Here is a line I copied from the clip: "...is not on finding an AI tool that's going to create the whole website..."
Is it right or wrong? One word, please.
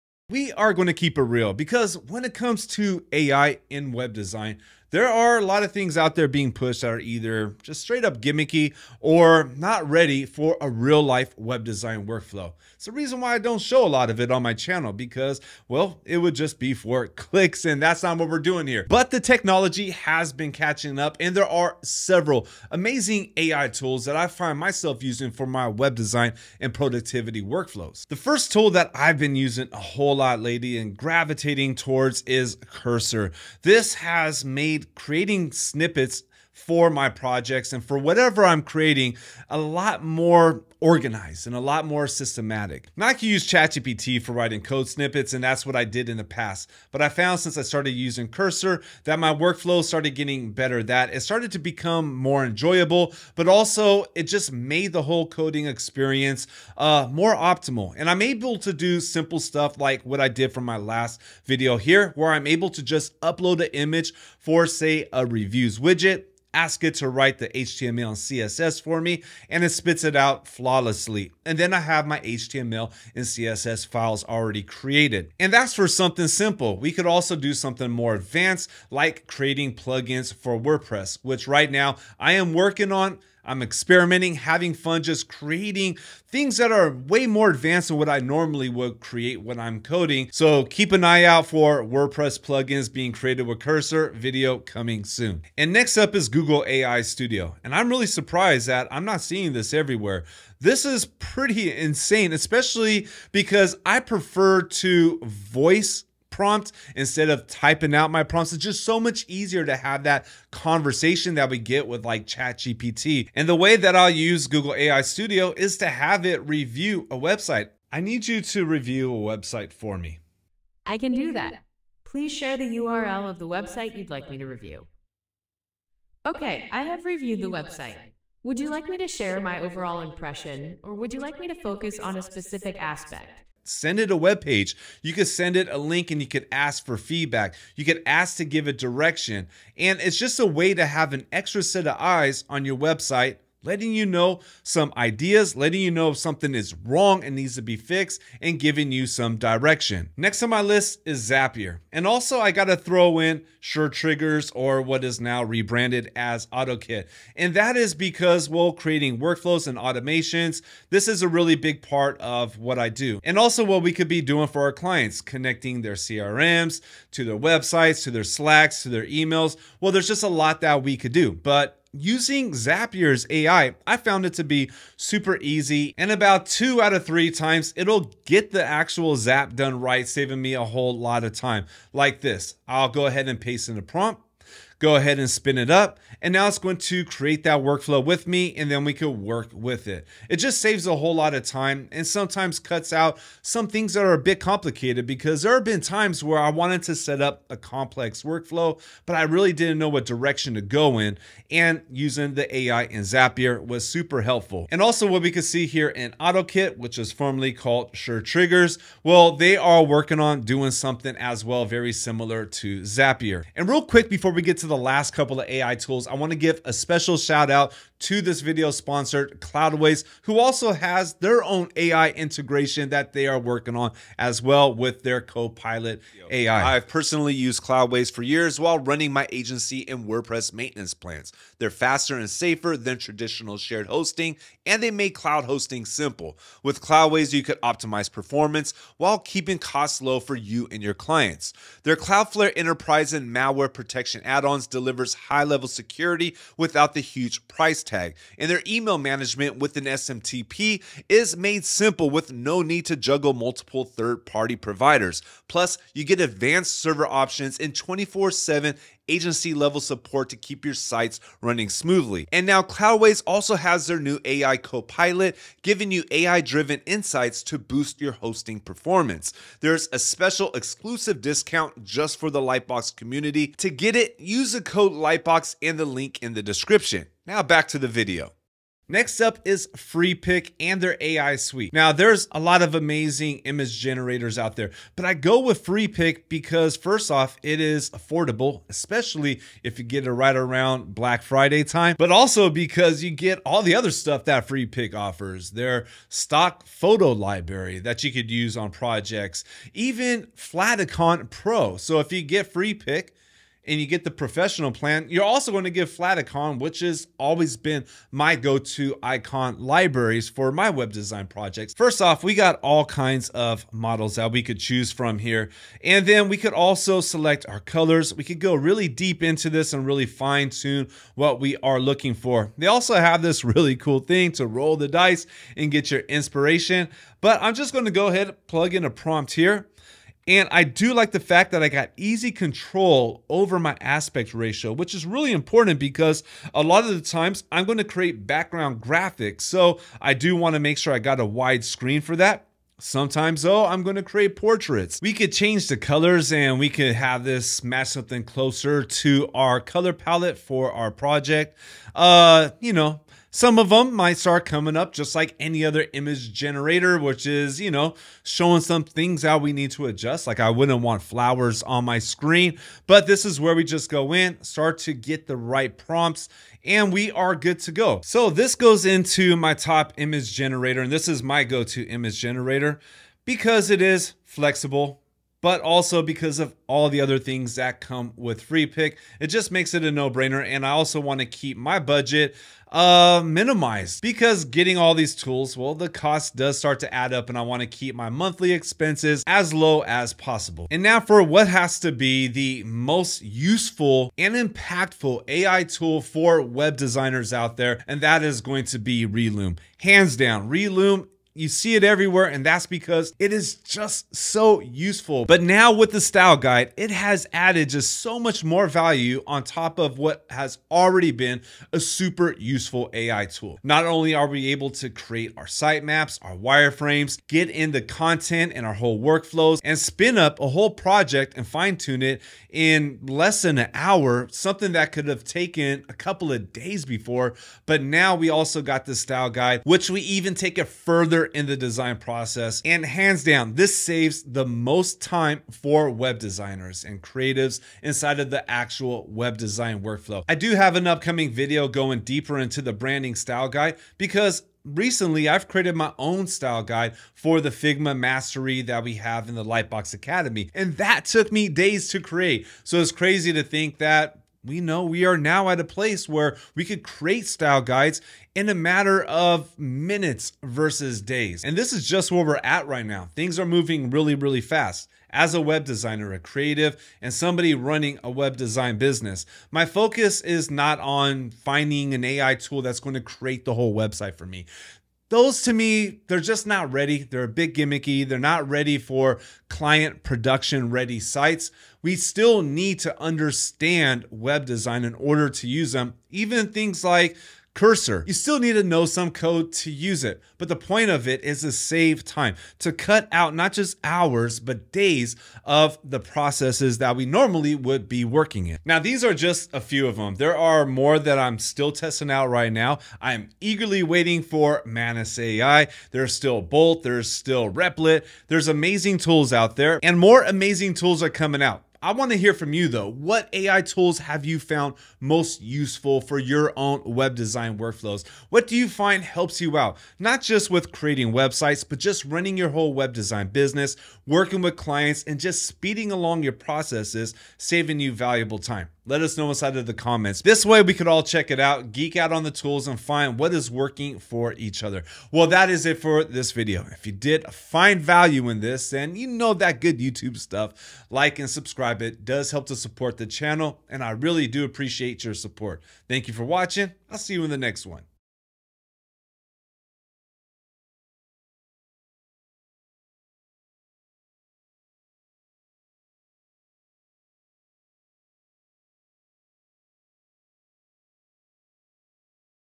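right.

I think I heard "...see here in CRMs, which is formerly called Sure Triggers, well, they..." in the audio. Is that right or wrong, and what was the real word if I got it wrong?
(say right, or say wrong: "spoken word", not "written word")
wrong: "OttoKit", not "CRMs".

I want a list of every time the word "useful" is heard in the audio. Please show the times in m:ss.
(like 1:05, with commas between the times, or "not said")
6:33, 6:44, 6:52, 8:35.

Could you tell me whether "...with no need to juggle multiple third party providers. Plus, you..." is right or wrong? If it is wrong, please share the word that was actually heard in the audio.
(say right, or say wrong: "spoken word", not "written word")
right.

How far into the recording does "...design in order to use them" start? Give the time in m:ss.
8:04.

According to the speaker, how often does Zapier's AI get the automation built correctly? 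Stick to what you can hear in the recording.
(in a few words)
2 out of 3 times.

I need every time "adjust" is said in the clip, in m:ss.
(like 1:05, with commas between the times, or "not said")
5:59.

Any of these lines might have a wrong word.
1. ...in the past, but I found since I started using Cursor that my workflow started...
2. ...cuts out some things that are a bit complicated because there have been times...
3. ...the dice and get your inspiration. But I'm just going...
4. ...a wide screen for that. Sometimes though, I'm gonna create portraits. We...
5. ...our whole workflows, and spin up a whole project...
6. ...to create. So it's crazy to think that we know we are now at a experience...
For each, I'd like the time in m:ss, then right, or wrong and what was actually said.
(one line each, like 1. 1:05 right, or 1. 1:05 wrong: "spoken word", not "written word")
1. 0:46 right
2. 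3:12 right
3. 5:24 right
4. 5:41 right
5. 6:58 right
6. 7:31 wrong: "place", not "experience".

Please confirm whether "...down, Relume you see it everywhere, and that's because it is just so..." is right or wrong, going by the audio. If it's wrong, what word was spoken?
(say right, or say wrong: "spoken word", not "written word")
right.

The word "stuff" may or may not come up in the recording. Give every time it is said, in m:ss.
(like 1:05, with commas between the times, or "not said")
0:59, 4:53, 9:00.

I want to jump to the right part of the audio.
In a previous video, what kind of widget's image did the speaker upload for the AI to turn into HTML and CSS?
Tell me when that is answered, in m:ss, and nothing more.
1:05.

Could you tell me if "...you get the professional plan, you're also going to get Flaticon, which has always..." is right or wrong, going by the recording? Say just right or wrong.
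right.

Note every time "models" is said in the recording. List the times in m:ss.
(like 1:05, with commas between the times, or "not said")
5:13.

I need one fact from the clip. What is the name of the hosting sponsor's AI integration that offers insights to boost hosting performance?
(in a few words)
Copilot AI.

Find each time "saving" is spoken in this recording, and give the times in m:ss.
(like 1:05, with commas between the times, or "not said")
3:00, 8:47.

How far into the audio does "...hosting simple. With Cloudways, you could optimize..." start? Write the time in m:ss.
3:55.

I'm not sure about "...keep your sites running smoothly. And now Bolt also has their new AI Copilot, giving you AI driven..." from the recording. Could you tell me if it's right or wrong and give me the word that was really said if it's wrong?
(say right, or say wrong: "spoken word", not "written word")
wrong: "Cloudways", not "Bolt".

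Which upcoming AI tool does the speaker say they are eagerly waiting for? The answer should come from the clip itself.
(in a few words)
Manus AI.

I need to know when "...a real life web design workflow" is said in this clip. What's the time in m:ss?
0:10.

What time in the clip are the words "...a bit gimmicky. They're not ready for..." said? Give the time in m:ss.
7:57.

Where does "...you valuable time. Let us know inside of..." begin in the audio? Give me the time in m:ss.
8:47.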